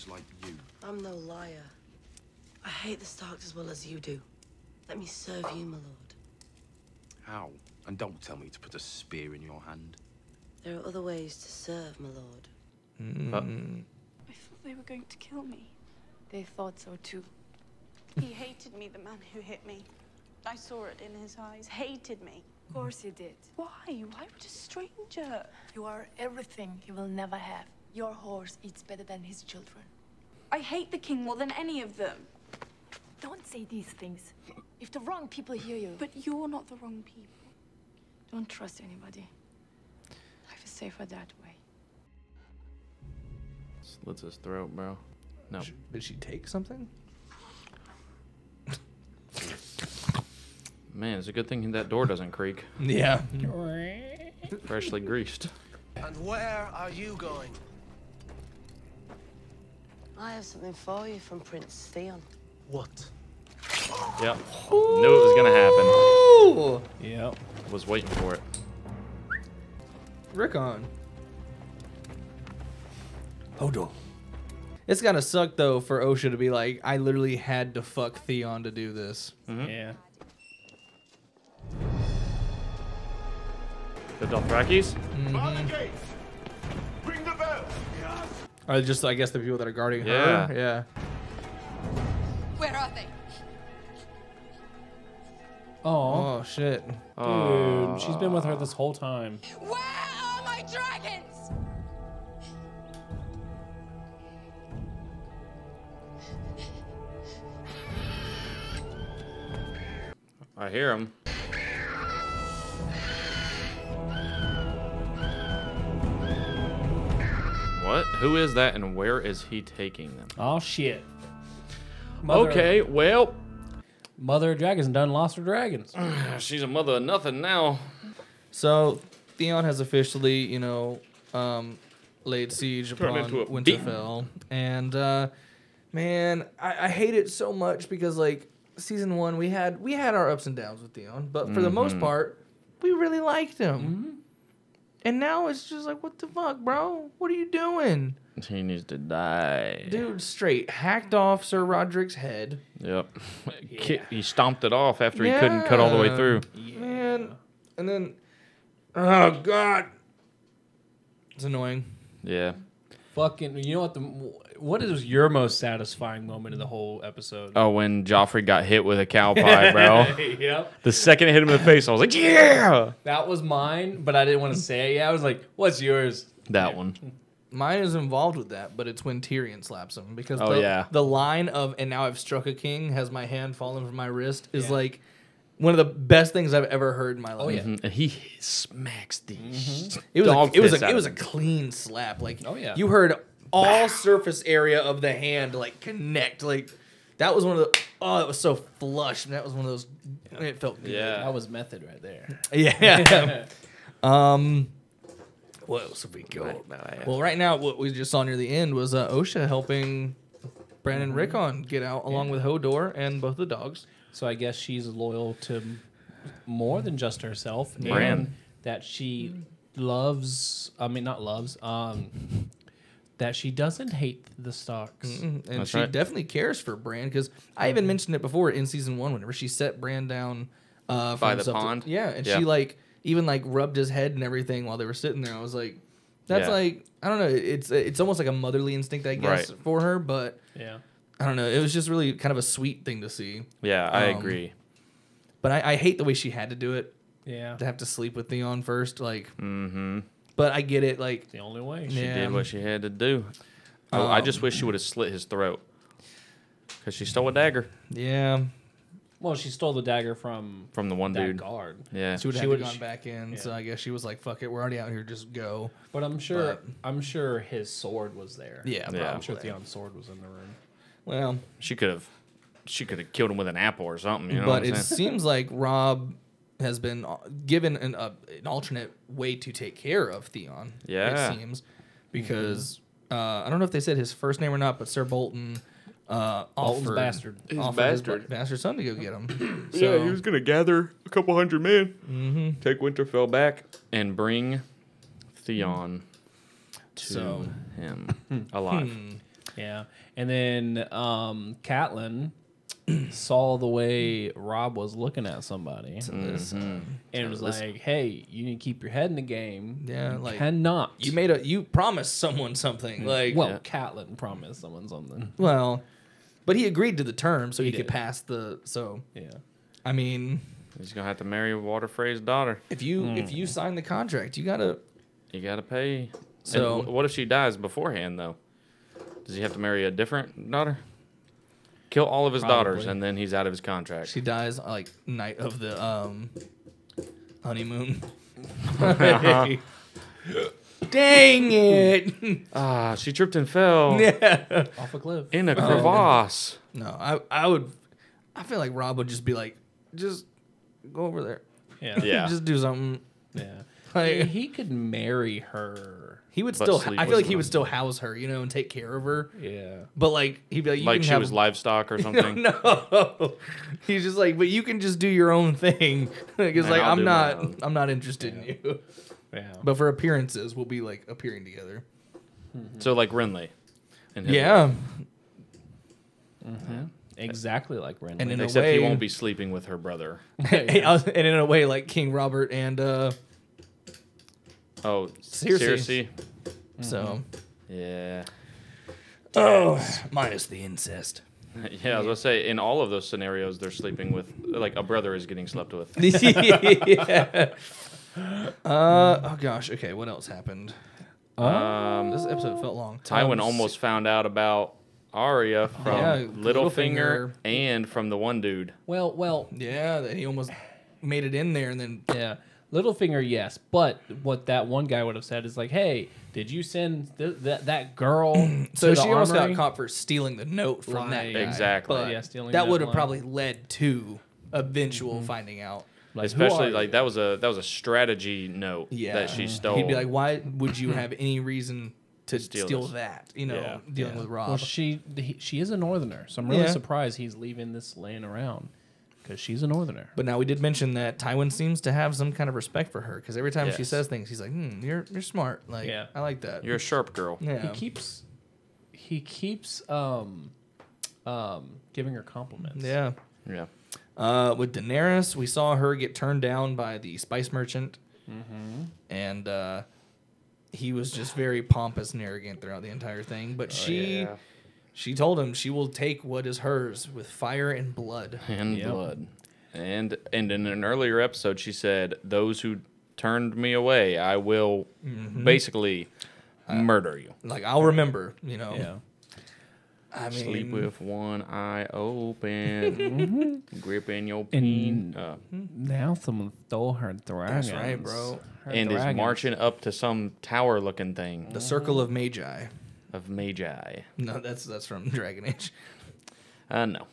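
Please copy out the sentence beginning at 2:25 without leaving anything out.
And now it's just like, what the fuck, bro?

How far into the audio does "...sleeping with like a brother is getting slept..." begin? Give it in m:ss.
6:33.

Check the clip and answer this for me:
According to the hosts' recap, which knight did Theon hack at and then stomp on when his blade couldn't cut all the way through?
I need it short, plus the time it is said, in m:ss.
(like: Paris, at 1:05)
Sir Rodrik, at 2:31.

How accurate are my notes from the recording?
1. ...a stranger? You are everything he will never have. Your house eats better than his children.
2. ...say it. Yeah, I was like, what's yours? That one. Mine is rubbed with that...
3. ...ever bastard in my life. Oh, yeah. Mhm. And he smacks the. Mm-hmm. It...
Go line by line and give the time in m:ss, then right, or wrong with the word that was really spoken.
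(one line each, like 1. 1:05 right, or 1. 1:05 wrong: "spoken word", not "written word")
1. 0:24 wrong: "horse", not "house"
2. 2:54 wrong: "involved", not "rubbed"
3. 3:06 wrong: "heard", not "bastard".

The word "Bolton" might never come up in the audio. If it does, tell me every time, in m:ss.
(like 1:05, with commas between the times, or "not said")
4:45.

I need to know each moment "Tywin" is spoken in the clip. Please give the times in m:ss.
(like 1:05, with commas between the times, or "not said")
6:43, 7:21.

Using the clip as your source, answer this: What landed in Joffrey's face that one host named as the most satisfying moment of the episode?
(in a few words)
A cow pie.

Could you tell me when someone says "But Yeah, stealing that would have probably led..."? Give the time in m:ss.
7:01.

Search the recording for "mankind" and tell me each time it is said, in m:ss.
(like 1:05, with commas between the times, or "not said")
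not said.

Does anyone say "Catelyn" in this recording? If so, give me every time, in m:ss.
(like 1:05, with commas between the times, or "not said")
5:01, 5:13.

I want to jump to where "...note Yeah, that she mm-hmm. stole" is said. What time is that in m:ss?
7:08.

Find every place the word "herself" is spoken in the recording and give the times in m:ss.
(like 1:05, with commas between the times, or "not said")
3:37.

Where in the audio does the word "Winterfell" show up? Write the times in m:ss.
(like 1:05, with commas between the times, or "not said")
2:13, 4:52.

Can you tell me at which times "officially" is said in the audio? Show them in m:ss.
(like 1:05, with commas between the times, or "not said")
2:09.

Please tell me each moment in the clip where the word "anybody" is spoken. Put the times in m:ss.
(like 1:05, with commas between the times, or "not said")
0:38.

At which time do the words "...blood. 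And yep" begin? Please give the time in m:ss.
7:47.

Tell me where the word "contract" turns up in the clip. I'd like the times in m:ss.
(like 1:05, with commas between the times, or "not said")
5:23, 5:33.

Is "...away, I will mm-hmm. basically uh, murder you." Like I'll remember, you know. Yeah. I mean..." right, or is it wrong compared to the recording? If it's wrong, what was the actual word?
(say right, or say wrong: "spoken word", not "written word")
right.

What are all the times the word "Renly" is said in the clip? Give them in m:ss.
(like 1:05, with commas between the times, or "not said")
6:13, 6:17.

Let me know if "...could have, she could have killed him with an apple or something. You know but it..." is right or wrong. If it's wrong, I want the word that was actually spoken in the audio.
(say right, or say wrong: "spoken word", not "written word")
right.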